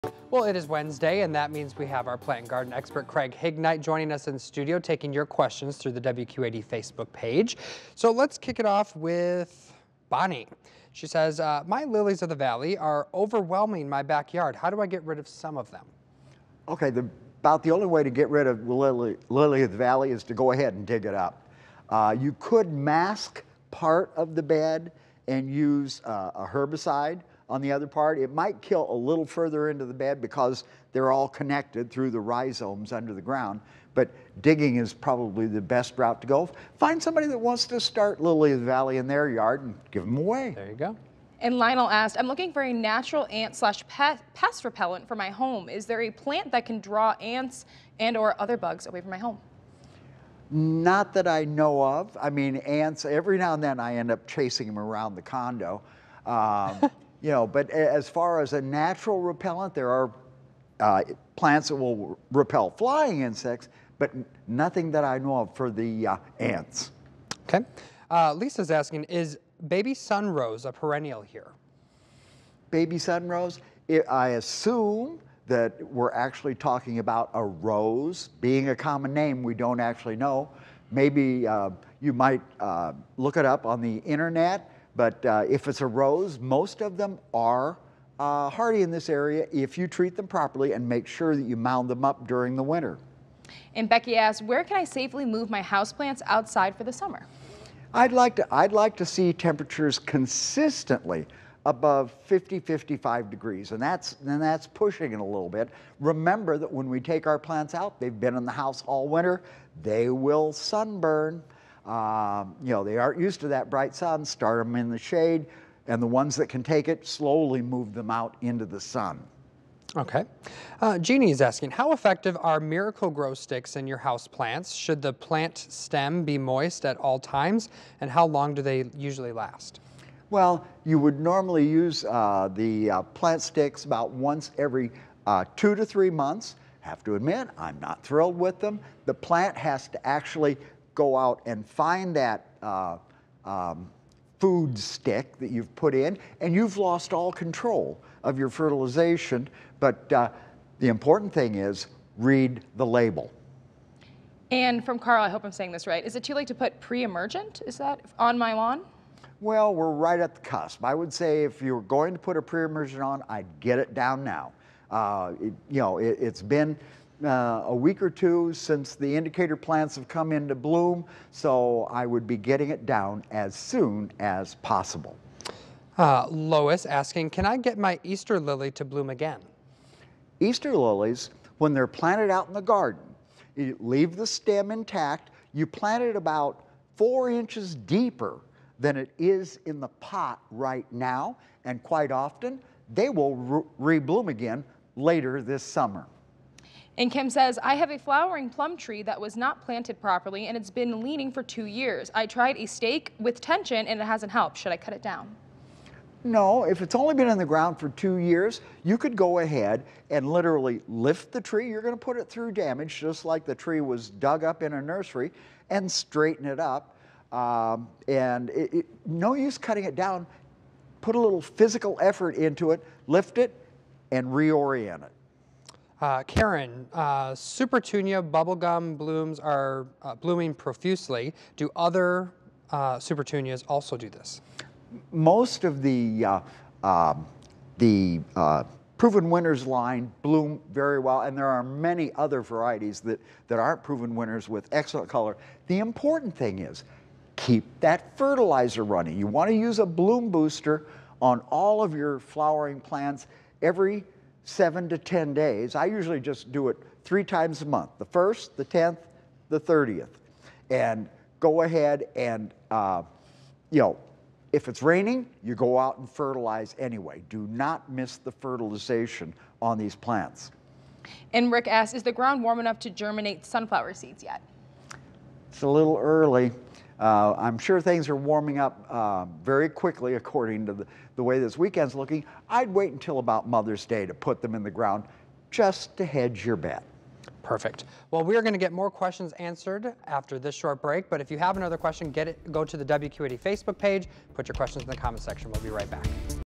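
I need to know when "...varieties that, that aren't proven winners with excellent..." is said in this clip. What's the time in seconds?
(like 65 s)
242 s.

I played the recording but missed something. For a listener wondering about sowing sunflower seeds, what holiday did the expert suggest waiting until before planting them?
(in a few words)
Mother's Day.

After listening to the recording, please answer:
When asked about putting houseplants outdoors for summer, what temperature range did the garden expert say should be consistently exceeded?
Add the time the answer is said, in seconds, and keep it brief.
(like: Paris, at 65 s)
50 to 55 degrees, at 102 s.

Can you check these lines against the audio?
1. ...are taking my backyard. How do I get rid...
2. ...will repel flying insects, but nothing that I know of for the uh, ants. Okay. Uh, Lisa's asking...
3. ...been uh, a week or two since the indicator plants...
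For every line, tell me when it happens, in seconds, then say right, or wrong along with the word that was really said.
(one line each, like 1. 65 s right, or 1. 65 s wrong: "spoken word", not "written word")
1. 12 s wrong: "overwhelming", not "taking"
2. 61 s right
3. 166 s right.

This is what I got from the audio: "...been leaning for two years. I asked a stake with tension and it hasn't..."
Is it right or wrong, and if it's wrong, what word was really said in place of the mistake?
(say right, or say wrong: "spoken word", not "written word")
wrong: "tried", not "asked".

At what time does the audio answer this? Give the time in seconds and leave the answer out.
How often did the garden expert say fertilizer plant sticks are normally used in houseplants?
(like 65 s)
135 s.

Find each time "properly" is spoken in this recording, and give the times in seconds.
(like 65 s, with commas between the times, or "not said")
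90 s, 200 s.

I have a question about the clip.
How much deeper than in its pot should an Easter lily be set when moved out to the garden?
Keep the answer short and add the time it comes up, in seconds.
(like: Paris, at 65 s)
4 inches, at 186 s.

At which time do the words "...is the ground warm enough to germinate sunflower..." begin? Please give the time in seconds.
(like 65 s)
271 s.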